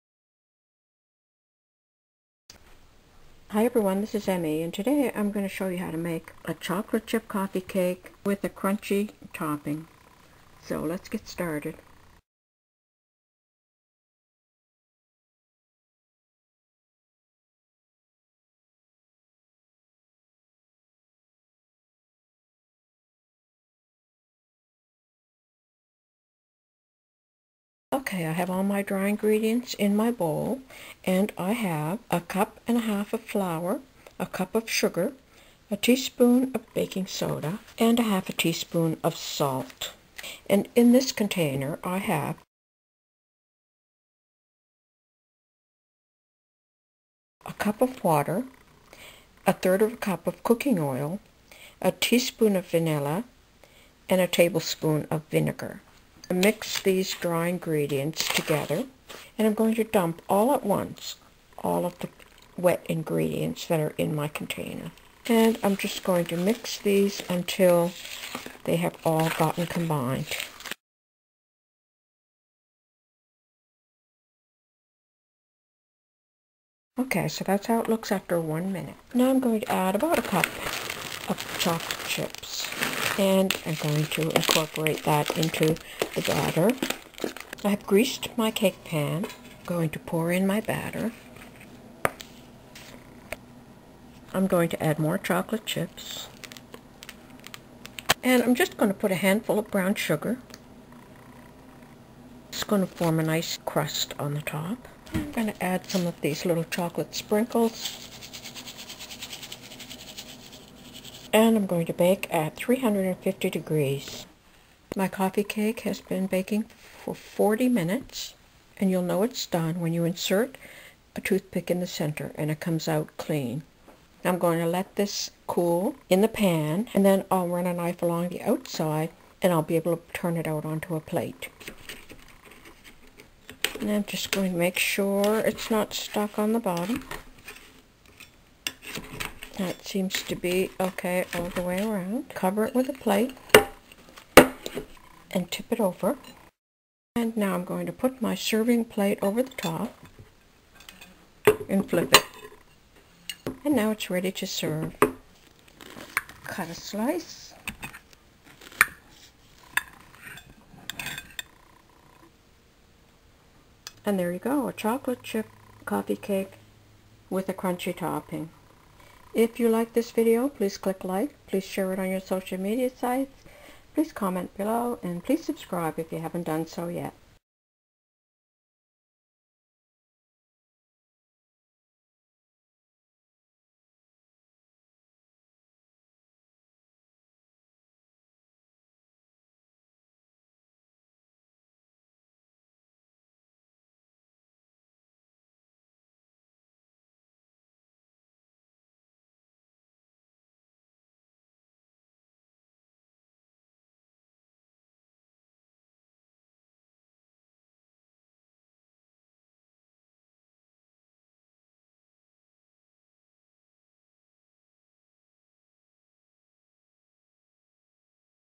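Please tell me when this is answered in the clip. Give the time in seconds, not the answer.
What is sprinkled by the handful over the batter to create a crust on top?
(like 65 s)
99 s.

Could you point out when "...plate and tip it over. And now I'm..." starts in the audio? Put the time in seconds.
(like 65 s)
142 s.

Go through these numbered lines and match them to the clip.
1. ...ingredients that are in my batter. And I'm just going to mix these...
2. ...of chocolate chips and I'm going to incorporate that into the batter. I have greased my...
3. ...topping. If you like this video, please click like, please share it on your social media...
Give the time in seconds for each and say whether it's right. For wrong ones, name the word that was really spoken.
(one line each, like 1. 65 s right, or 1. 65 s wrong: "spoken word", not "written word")
1. 62 s wrong: "container", not "batter"
2. 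81 s right
3. 167 s right.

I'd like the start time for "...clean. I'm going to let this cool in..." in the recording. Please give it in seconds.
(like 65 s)
123 s.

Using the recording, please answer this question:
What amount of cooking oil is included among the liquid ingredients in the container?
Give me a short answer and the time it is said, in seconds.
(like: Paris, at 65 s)
1/3 cup, at 49 s.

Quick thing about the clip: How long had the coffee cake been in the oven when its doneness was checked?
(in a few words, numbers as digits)
40 minutes.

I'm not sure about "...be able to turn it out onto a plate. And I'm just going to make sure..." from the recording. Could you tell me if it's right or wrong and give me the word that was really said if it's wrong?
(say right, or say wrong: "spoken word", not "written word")
right.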